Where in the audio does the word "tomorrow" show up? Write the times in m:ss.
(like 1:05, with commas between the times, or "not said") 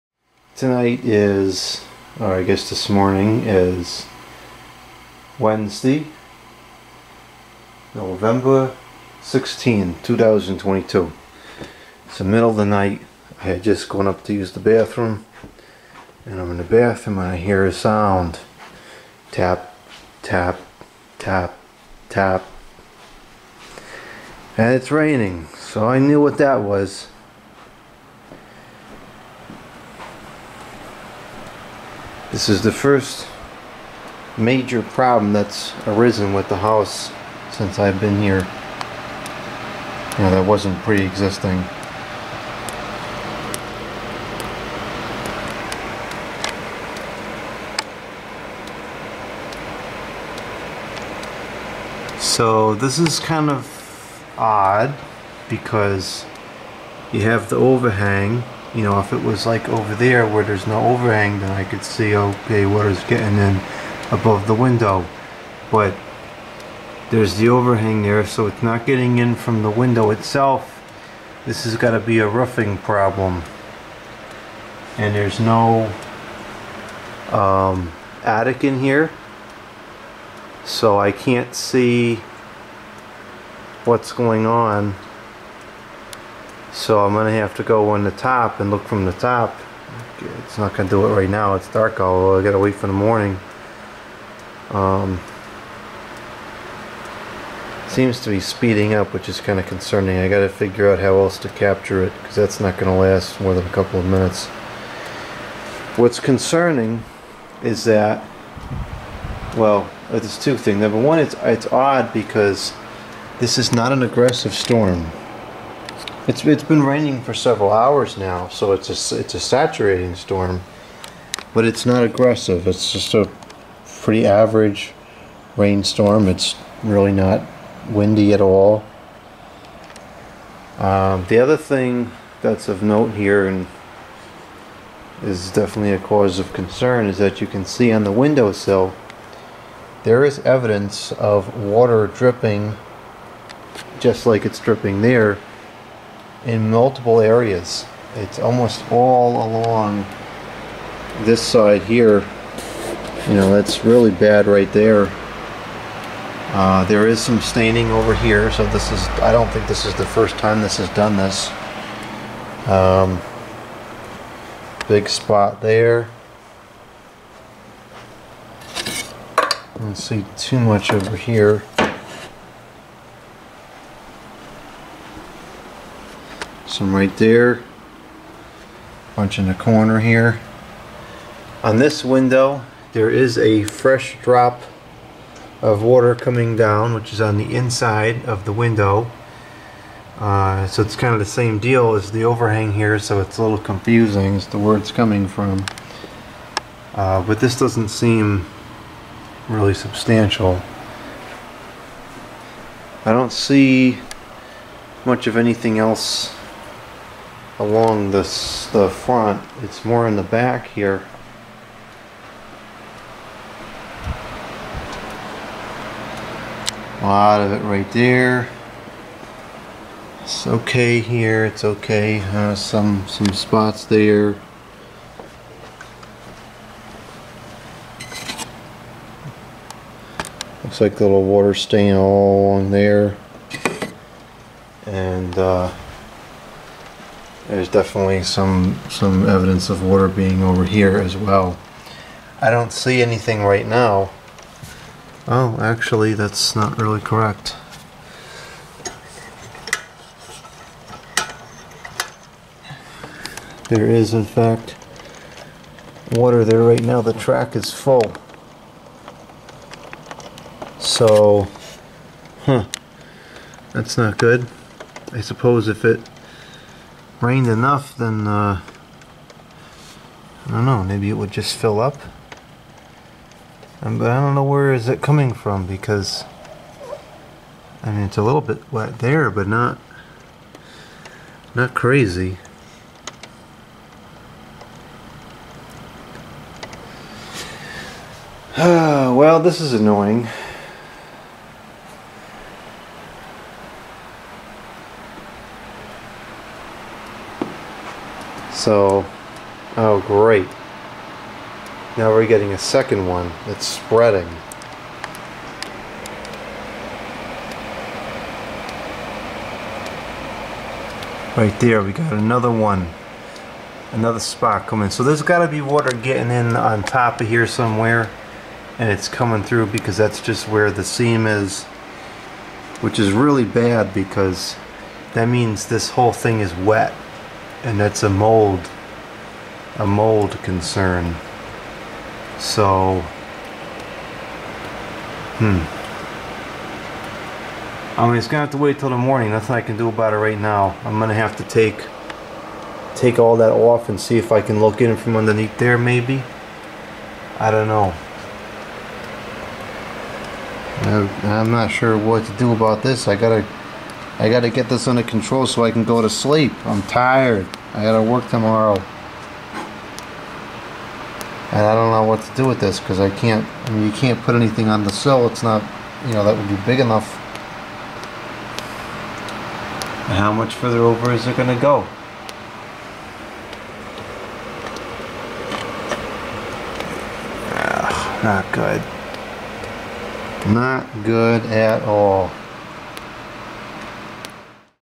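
5:58.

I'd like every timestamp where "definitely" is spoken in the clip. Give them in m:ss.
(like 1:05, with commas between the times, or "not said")
2:15, 3:57.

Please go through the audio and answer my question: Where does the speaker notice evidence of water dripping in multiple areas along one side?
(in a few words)
windowsill.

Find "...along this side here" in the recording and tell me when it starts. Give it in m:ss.
2:29.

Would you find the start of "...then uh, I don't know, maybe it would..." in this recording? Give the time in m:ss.
4:27.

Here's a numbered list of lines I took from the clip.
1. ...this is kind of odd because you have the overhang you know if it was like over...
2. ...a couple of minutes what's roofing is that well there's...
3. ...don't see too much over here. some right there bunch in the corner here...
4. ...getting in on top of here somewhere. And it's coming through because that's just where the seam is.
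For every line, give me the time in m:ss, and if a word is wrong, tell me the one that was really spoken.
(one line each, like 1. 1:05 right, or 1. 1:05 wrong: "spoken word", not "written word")
1. 0:52 right
2. 1:43 wrong: "concerning", not "roofing"
3. 2:49 right
4. 5:15 right.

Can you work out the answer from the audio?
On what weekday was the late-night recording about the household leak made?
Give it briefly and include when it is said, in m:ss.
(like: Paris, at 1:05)
Wednesday, at 0:05.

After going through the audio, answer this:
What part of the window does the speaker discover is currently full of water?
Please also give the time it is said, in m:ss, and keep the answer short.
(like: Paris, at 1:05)
The track, at 4:17.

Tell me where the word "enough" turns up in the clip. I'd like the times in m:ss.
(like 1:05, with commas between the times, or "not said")
4:27, 6:06.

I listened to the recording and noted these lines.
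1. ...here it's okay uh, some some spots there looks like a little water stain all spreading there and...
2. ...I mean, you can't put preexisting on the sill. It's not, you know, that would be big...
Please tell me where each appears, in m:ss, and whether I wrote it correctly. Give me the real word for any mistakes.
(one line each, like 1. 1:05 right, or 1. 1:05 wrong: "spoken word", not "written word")
1. 3:40 wrong: "along", not "spreading"
2. 6:03 wrong: "anything", not "preexisting".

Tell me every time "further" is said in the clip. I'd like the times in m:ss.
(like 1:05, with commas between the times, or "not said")
6:10.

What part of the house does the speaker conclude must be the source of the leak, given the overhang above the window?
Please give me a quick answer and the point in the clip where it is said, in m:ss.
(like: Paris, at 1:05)
roofing, at 1:12.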